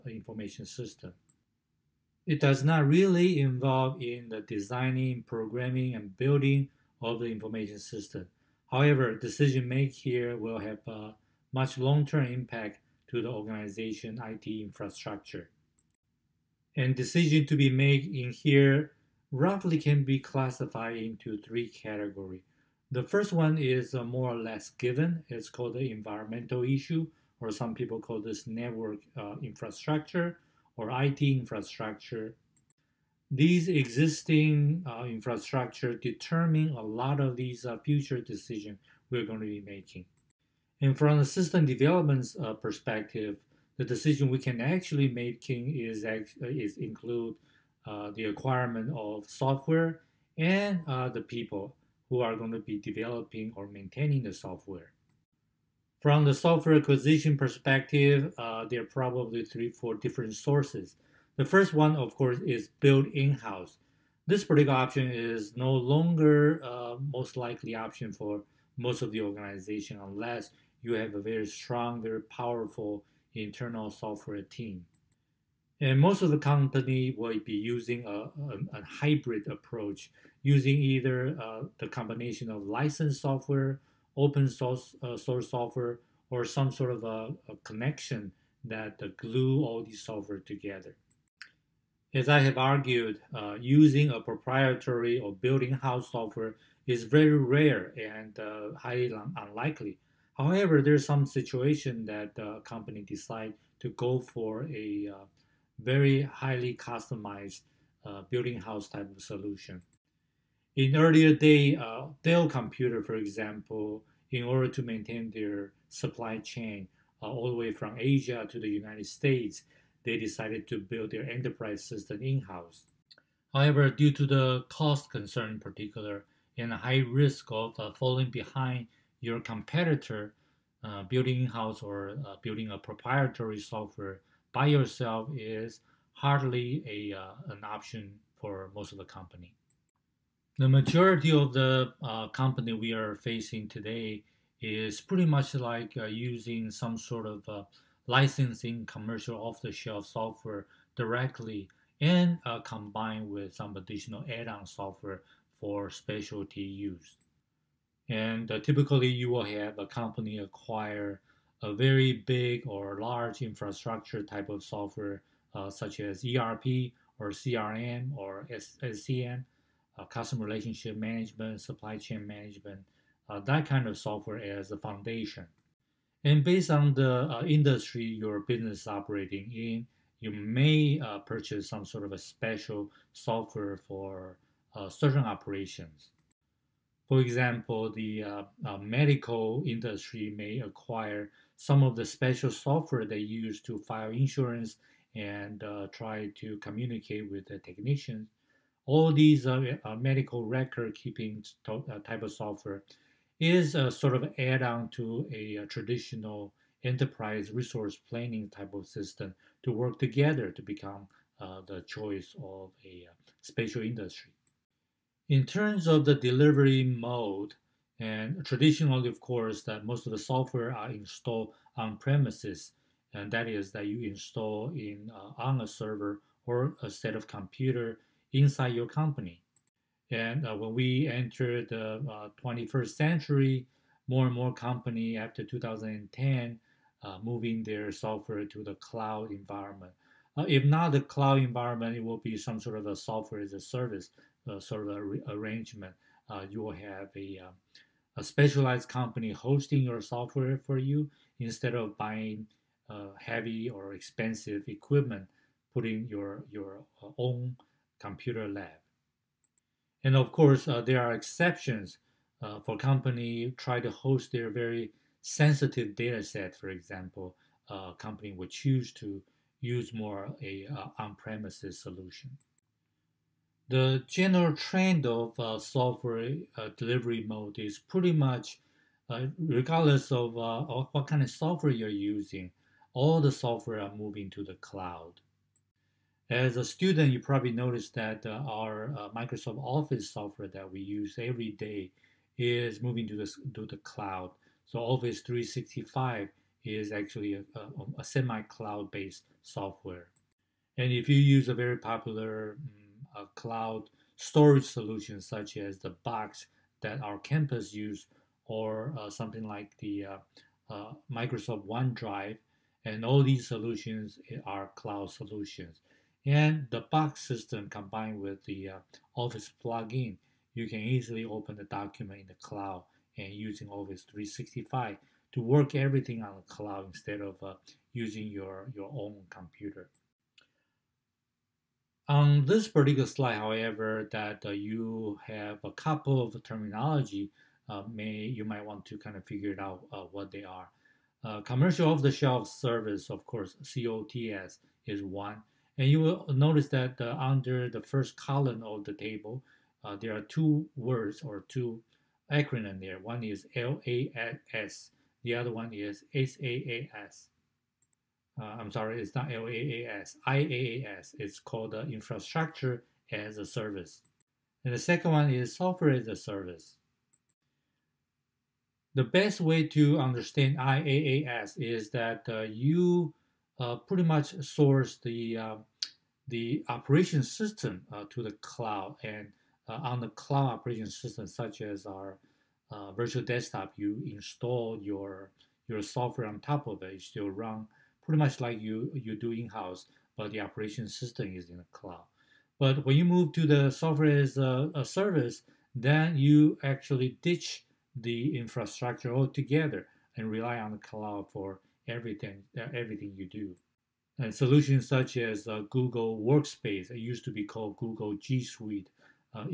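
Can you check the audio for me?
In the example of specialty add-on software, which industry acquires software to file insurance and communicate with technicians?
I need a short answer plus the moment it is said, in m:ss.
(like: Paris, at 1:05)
medical industry, at 3:08.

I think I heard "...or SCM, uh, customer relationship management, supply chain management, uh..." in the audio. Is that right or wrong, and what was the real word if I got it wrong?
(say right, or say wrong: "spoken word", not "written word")
right.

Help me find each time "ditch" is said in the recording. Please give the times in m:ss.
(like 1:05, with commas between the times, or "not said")
6:37.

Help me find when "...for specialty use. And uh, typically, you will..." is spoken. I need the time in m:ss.
2:35.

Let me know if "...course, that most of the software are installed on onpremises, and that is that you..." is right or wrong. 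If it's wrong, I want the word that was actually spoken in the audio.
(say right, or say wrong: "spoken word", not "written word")
wrong: "premises", not "onpremises".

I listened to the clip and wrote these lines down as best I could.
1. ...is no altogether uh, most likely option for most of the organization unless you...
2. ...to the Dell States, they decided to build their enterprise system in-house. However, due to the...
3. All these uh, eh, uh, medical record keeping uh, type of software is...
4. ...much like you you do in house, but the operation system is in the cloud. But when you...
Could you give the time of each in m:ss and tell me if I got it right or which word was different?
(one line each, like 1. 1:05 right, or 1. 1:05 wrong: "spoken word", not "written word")
1. 1:05 wrong: "longer", not "altogether"
2. 1:58 wrong: "United", not "Dell"
3. 3:18 right
4. 6:28 right.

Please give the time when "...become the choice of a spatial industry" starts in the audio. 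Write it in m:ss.
3:30.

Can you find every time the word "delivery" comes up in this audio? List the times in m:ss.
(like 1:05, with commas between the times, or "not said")
3:36, 4:36.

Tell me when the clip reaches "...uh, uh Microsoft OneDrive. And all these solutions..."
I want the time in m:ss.
5:10.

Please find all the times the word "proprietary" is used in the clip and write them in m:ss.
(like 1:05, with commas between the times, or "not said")
1:34, 2:12.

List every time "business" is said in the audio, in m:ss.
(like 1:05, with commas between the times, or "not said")
2:58.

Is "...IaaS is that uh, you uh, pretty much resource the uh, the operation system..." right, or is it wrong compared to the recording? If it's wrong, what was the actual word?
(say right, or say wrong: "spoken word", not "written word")
wrong: "source", not "resource".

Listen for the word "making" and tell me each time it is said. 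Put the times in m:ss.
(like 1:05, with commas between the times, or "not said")
0:39, 0:45.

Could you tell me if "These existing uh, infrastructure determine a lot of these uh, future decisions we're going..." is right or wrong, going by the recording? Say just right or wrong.
right.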